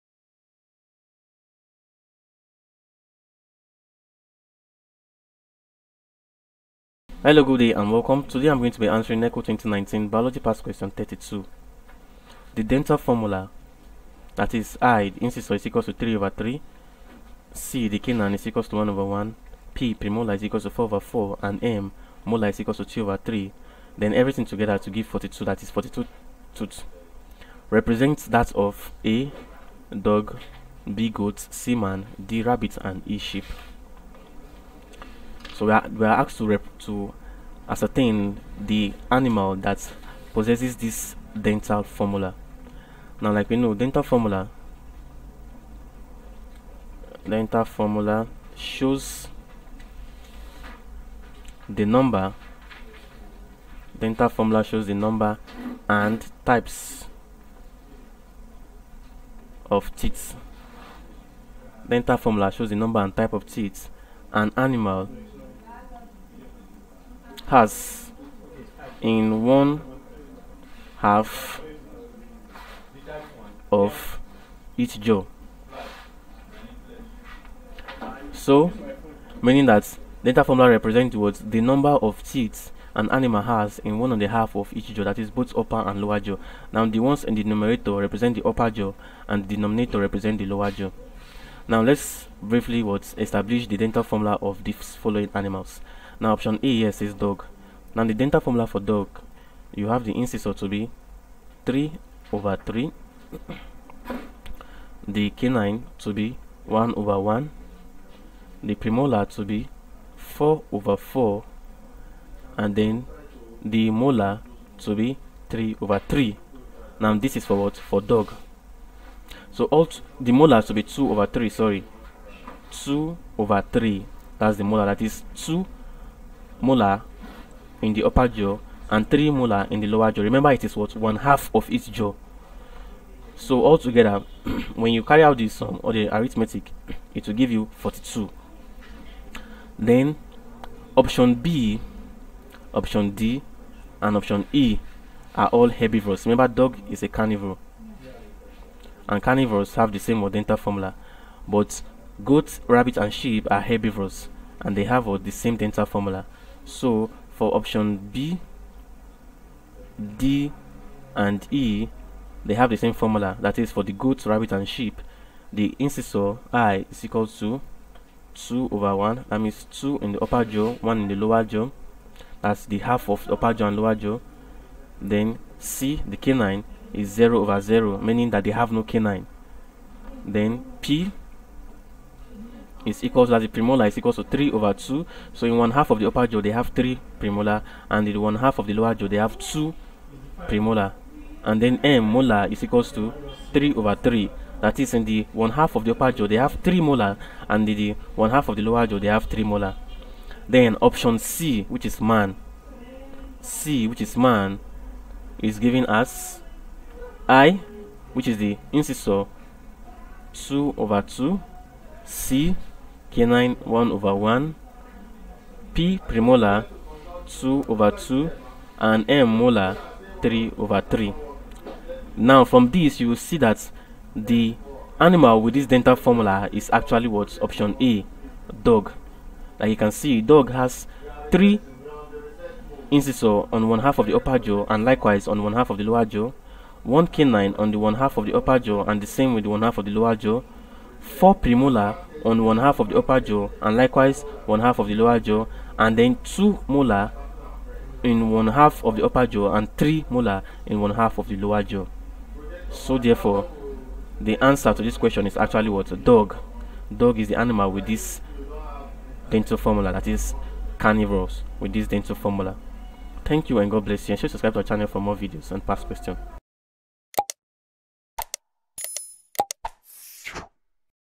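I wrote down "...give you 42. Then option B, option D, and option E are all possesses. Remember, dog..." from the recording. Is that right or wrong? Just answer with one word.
wrong.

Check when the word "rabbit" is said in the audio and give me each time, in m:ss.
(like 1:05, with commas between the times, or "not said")
0:32, 2:32, 2:44.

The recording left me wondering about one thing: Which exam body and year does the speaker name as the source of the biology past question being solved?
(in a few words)
NECO 2019.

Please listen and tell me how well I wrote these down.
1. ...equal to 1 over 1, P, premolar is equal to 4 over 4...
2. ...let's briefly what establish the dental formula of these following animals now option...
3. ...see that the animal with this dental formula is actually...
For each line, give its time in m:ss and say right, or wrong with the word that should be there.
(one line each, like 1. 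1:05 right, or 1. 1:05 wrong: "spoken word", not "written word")
1. 0:18 right
2. 1:31 right
3. 3:43 right.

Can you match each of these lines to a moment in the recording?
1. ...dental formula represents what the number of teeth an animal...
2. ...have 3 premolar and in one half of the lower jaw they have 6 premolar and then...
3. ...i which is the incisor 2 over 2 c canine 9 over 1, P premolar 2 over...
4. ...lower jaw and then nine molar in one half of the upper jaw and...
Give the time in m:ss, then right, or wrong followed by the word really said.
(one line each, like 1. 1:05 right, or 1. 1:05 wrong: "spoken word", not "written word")
1. 1:20 right
2. 3:06 wrong: "2", not "6"
3. 3:27 wrong: "1", not "9"
4. 4:04 wrong: "two", not "nine".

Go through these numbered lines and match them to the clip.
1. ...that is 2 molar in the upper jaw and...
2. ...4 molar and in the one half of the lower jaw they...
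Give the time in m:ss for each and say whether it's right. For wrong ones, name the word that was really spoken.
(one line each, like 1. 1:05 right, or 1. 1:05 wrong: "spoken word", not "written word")
1. 2:04 right
2. 3:16 wrong: "3", not "4".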